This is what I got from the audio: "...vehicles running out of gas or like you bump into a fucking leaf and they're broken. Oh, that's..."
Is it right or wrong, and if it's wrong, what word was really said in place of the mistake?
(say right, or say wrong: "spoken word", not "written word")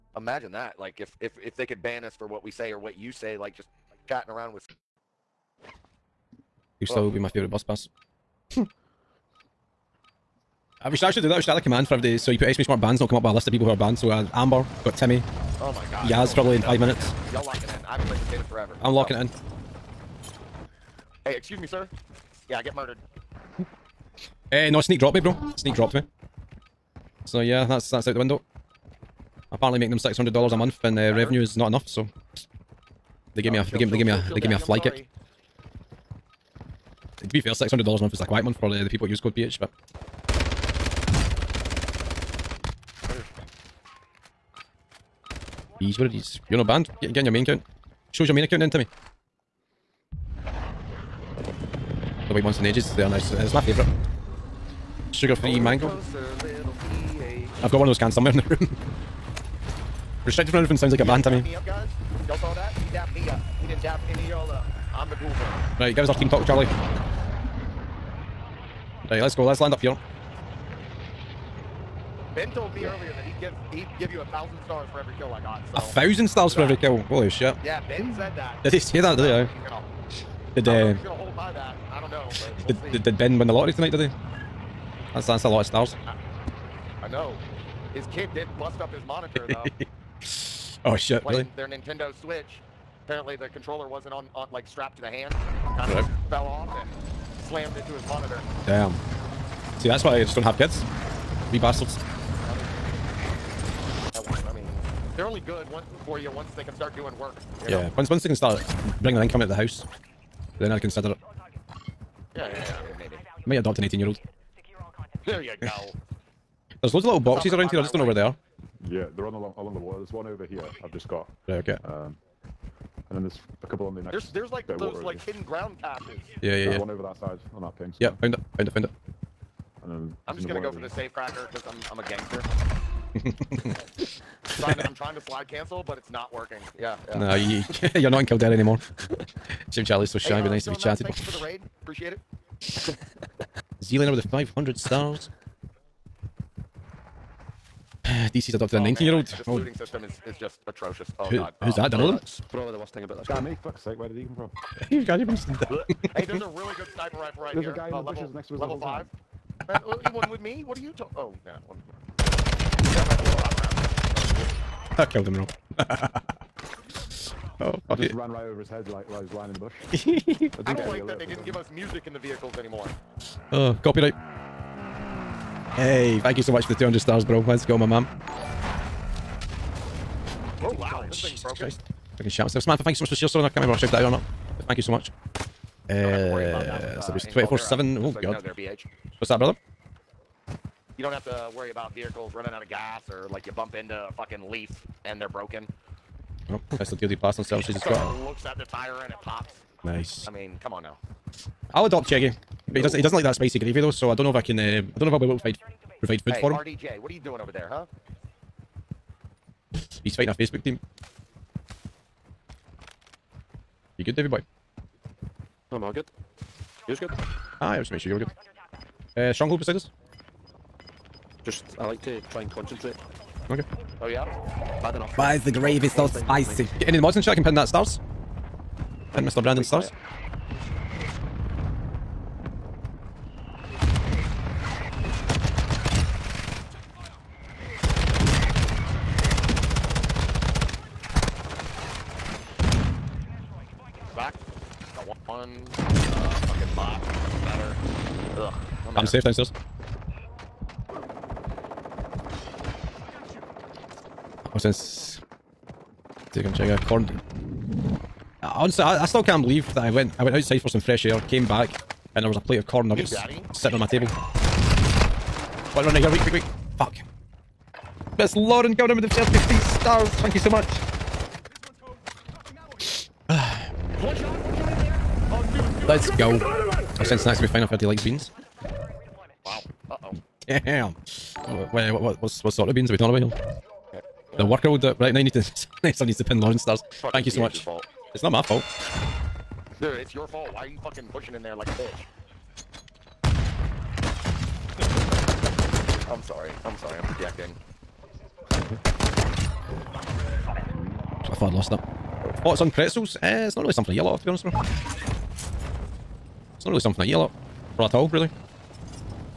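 right.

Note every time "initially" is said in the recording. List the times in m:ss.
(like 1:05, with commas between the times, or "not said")
not said.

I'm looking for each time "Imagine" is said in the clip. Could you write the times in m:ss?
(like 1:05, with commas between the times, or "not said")
0:00.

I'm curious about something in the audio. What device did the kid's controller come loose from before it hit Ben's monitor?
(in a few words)
Nintendo Switch.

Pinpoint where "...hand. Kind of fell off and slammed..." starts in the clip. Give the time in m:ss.
1:35.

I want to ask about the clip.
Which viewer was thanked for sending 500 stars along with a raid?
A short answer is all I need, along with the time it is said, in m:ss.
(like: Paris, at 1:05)
Zealander, at 2:23.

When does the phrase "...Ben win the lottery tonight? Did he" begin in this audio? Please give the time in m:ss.
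1:23.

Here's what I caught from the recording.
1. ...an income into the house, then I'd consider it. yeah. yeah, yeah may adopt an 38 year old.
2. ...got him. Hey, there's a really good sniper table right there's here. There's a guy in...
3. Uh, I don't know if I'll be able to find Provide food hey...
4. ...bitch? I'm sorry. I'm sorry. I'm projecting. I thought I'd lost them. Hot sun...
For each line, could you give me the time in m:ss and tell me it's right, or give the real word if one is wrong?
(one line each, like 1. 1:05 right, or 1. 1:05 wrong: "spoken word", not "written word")
1. 1:49 wrong: "18", not "38"
2. 2:35 wrong: "rifle", not "table"
3. 3:24 right
4. 4:51 right.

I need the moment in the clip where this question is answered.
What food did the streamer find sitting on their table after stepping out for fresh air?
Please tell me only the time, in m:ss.
4:22.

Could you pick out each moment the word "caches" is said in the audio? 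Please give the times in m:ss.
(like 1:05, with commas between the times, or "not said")
2:05.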